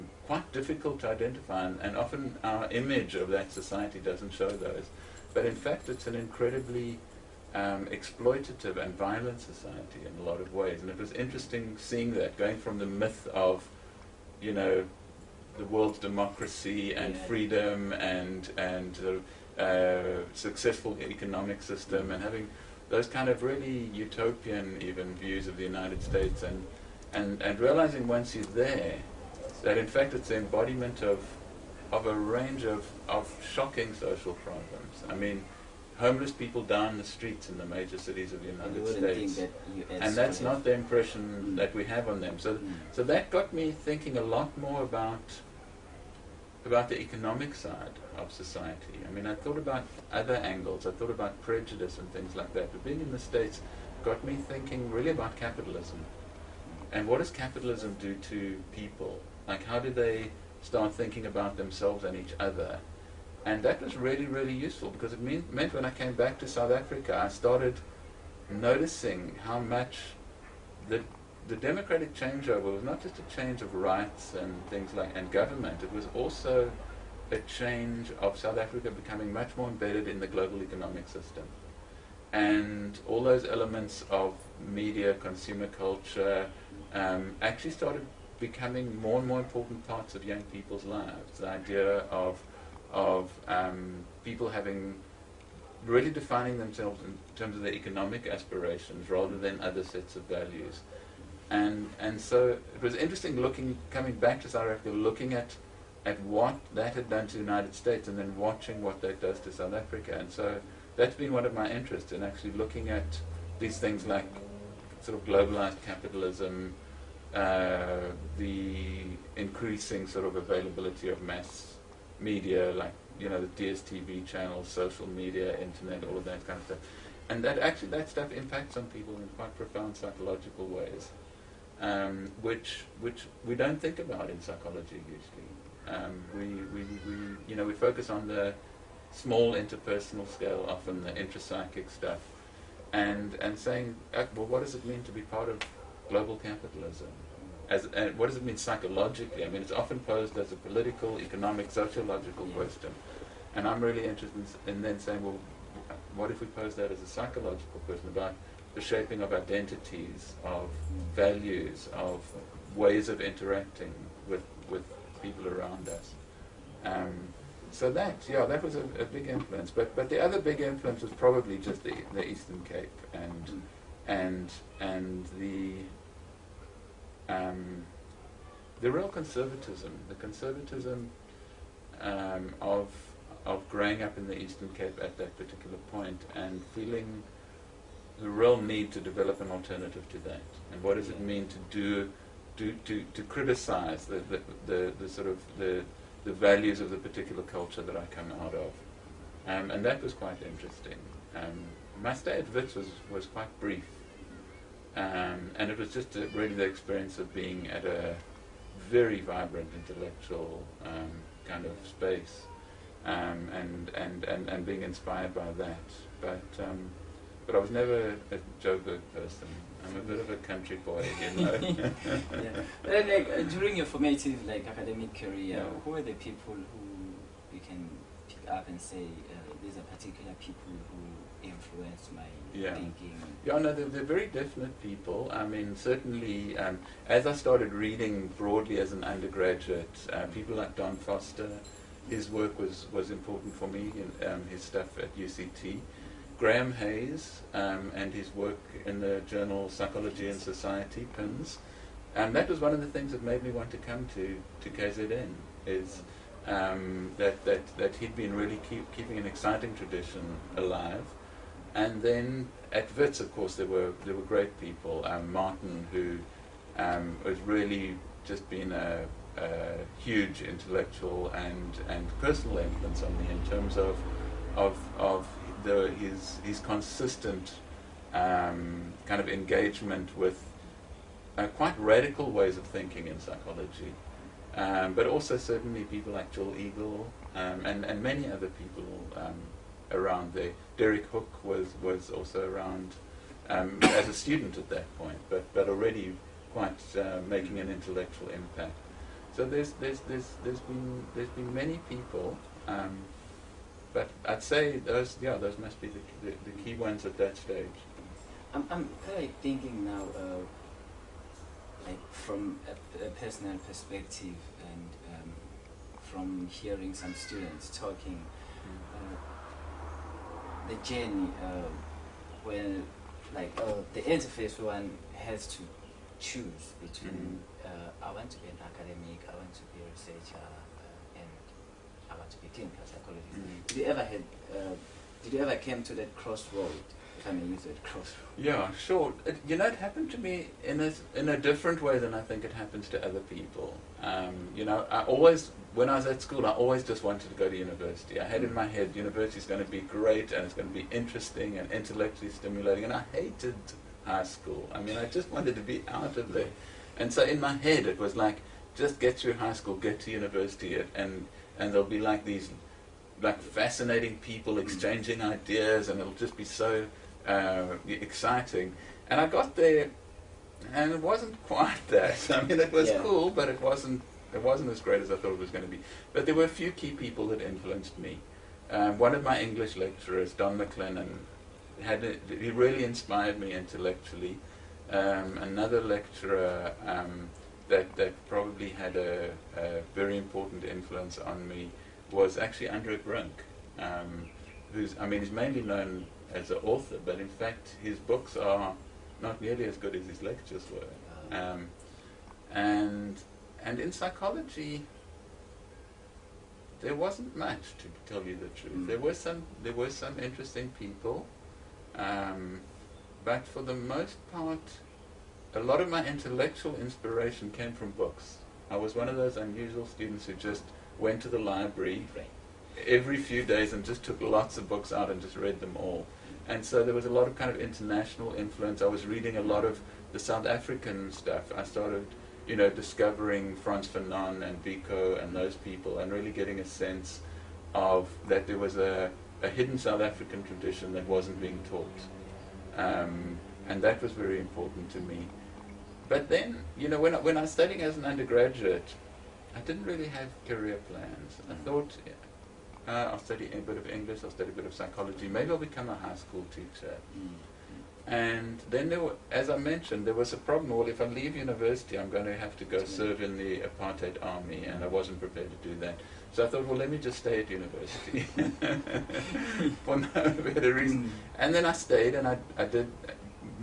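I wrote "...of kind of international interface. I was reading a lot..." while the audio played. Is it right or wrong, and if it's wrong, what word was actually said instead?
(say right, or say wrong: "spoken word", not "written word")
wrong: "influence", not "interface".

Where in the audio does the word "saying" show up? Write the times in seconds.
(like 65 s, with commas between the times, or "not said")
143 s, 154 s.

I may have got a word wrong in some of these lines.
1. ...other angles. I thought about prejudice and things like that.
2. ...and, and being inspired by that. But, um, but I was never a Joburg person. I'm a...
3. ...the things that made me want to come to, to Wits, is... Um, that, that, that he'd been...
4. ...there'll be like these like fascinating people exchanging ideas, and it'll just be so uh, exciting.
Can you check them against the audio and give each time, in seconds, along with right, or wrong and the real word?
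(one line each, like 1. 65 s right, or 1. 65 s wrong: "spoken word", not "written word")
1. 50 s right
2. 214 s right
3. 252 s wrong: "KZN", not "Wits"
4. 361 s right.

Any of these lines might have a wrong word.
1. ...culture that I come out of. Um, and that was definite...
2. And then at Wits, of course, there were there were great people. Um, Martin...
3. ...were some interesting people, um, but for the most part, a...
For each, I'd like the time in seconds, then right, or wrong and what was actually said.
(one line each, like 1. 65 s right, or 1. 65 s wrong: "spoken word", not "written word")
1. 197 s wrong: "quite", not "definite"
2. 261 s right
3. 409 s right.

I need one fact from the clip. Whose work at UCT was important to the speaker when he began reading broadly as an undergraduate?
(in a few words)
Don Foster.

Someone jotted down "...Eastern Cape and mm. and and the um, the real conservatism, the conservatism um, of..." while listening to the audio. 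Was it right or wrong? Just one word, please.
right.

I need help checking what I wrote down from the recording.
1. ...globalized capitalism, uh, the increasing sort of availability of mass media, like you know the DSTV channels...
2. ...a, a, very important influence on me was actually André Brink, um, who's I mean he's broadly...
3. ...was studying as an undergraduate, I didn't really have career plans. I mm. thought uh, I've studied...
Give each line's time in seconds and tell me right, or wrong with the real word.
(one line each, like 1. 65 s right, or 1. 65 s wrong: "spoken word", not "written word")
1. 115 s right
2. 388 s wrong: "mainly", not "broadly"
3. 447 s right.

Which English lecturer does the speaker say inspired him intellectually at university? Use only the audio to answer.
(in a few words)
Don Maclennan.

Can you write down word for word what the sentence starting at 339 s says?
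It, you know, it happened to me in a in a different way than I think it happens to other people.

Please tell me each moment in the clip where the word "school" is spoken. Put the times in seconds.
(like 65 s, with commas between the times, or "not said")
346 s, 354 s, 359 s, 456 s.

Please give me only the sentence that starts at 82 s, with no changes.
And all those elements of media, consumer culture, um, actually started becoming more and more important parts of young people's lives.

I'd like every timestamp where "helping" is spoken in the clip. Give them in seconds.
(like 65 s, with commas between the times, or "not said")
not said.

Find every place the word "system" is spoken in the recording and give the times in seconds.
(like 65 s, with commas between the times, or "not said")
21 s, 81 s.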